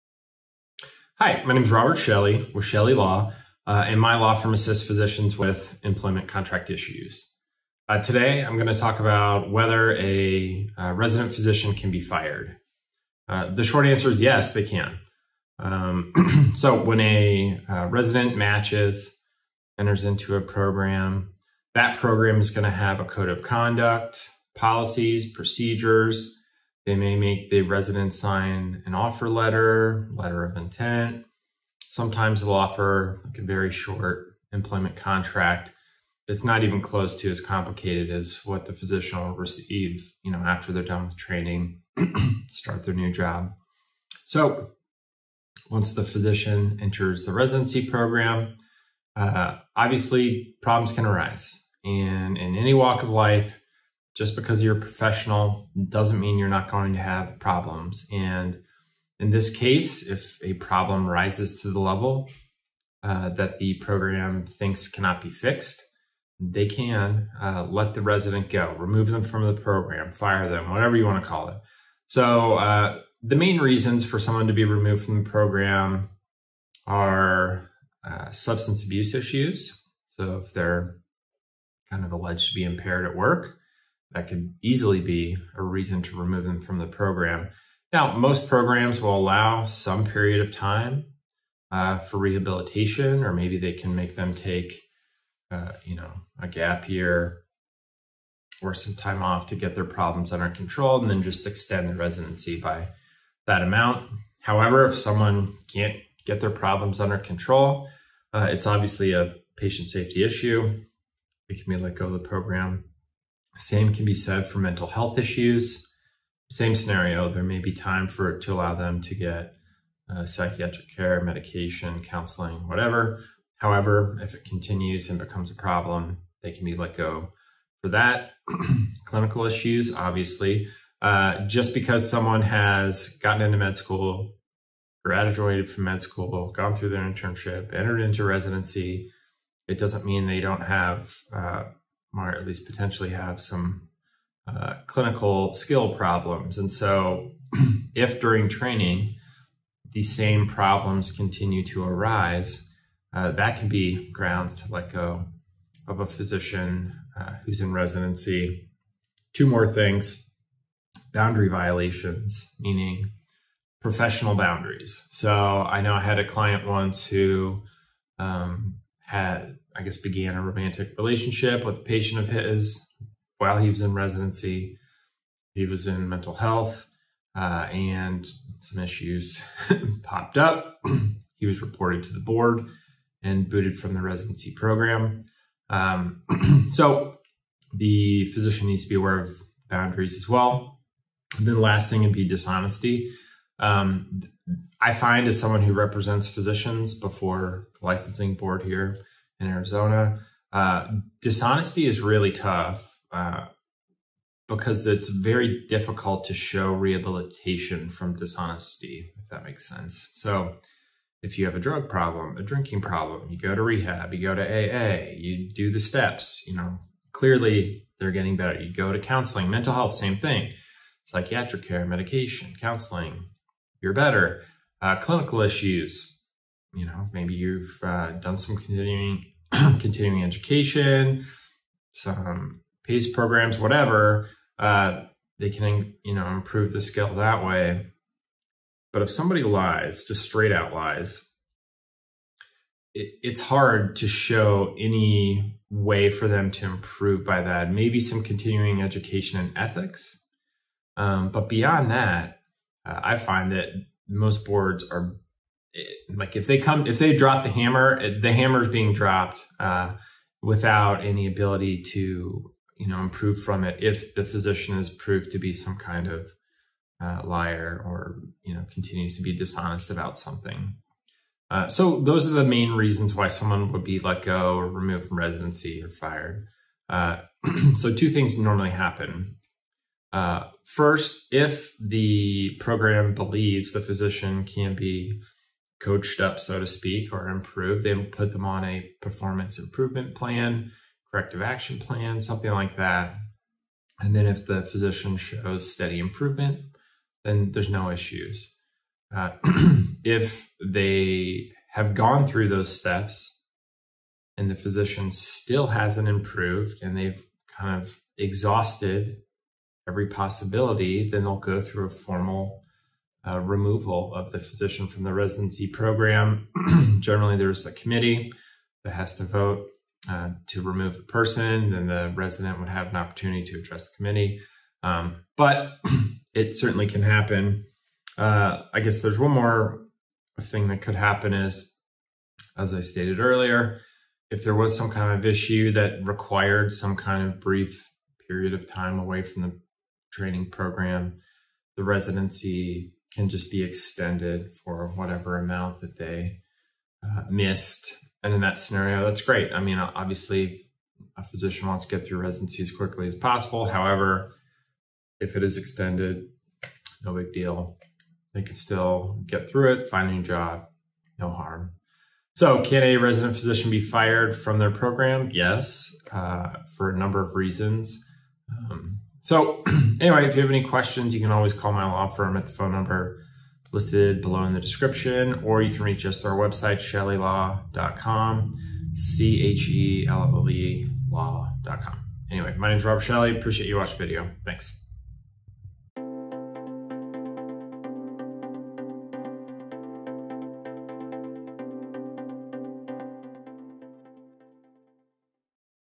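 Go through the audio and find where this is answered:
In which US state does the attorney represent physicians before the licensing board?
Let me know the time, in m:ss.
3:19.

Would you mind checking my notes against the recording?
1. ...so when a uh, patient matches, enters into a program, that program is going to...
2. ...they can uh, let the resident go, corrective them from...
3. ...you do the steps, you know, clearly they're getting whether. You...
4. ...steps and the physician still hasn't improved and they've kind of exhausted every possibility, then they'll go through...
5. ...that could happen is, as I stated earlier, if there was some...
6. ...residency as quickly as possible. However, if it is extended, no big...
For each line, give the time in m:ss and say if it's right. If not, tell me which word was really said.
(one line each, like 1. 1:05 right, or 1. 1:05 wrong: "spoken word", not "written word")
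1. 0:16 wrong: "resident", not "patient"
2. 1:06 wrong: "remove", not "corrective"
3. 3:35 wrong: "better", not "whether"
4. 5:02 right
5. 5:30 right
6. 5:52 right.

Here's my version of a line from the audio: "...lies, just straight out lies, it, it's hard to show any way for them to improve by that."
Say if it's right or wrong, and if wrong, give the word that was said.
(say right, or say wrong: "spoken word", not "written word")
right.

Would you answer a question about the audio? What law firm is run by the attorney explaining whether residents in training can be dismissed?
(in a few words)
Shelley Law.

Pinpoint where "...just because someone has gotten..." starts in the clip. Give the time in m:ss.
2:11.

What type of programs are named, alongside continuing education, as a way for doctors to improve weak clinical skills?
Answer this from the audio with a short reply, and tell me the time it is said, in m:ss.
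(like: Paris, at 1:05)
PACE programs, at 3:52.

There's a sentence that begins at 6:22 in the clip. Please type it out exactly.
Anyway, my name is Rob Shelley.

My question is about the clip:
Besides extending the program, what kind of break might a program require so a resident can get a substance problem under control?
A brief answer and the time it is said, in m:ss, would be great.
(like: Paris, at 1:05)
a gap year, at 1:36.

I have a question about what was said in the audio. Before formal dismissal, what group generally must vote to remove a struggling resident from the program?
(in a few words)
a committee.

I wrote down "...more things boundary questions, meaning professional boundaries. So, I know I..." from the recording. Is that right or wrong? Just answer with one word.
wrong.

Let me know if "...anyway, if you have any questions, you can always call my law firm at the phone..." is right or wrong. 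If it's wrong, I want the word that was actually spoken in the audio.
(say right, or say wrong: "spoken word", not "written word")
right.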